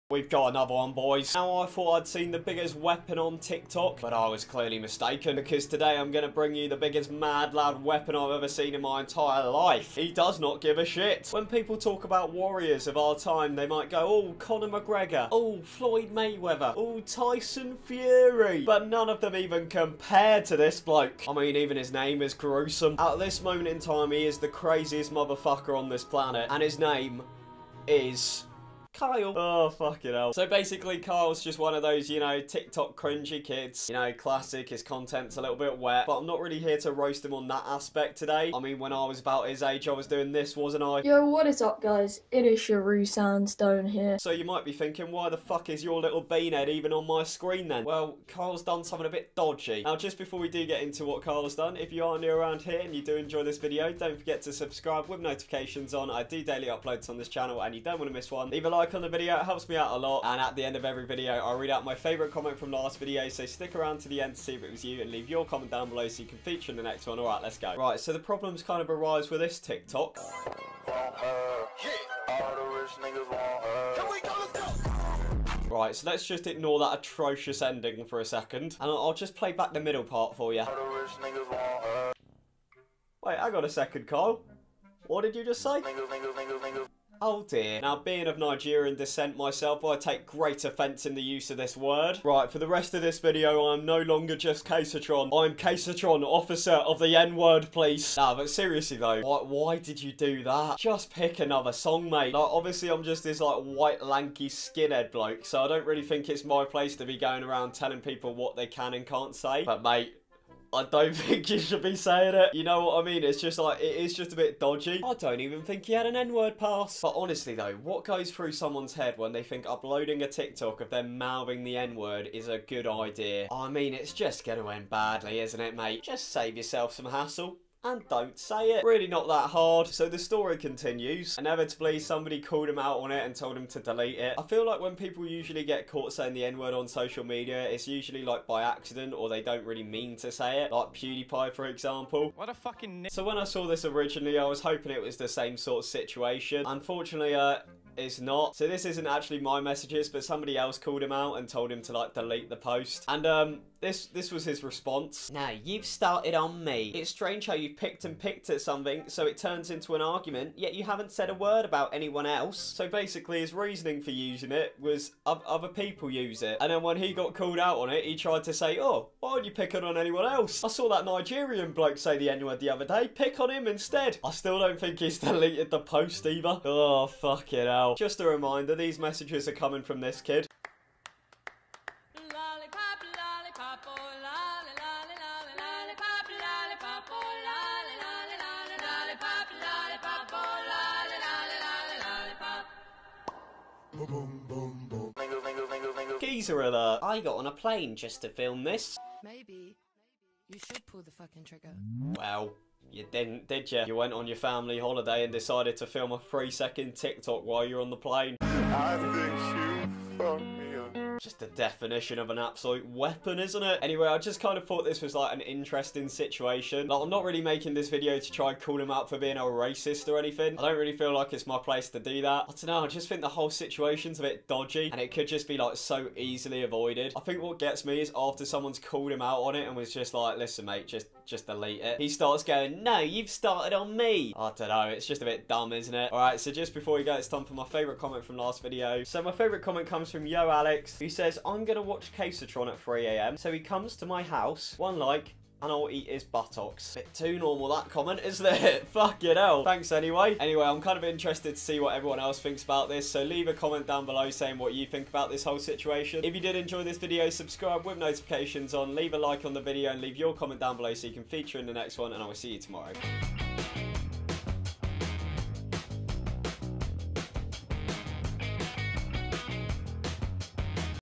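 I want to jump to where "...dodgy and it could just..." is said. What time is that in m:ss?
3:44.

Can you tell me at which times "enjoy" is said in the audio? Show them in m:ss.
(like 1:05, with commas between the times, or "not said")
0:53, 4:16.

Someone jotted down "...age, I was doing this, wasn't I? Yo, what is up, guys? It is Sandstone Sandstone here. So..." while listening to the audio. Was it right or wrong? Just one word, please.
wrong.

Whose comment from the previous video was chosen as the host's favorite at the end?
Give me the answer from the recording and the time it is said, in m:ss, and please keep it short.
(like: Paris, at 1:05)
Yo Alex, at 4:00.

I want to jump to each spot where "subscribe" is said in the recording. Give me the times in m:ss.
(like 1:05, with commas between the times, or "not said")
0:54, 4:17.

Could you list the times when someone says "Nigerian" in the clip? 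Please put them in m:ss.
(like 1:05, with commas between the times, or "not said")
1:28, 2:51.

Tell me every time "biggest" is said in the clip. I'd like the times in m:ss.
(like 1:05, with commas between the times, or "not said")
0:02, 0:06.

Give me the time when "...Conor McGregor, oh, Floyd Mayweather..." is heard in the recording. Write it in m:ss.
0:14.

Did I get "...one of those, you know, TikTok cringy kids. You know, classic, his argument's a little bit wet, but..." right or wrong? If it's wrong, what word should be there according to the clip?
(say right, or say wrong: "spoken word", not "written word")
wrong: "content", not "argument".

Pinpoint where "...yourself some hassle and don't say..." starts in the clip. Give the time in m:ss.
2:06.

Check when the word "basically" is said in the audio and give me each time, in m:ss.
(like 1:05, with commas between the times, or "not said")
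0:30, 2:42.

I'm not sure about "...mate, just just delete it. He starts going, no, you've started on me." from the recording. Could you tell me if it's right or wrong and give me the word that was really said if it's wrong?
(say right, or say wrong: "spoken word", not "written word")
right.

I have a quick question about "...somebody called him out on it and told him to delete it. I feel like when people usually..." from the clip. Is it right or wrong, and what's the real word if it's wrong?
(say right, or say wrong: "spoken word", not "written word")
right.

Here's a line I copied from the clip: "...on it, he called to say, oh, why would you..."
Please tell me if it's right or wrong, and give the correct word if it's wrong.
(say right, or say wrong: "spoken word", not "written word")
wrong: "tried", not "called".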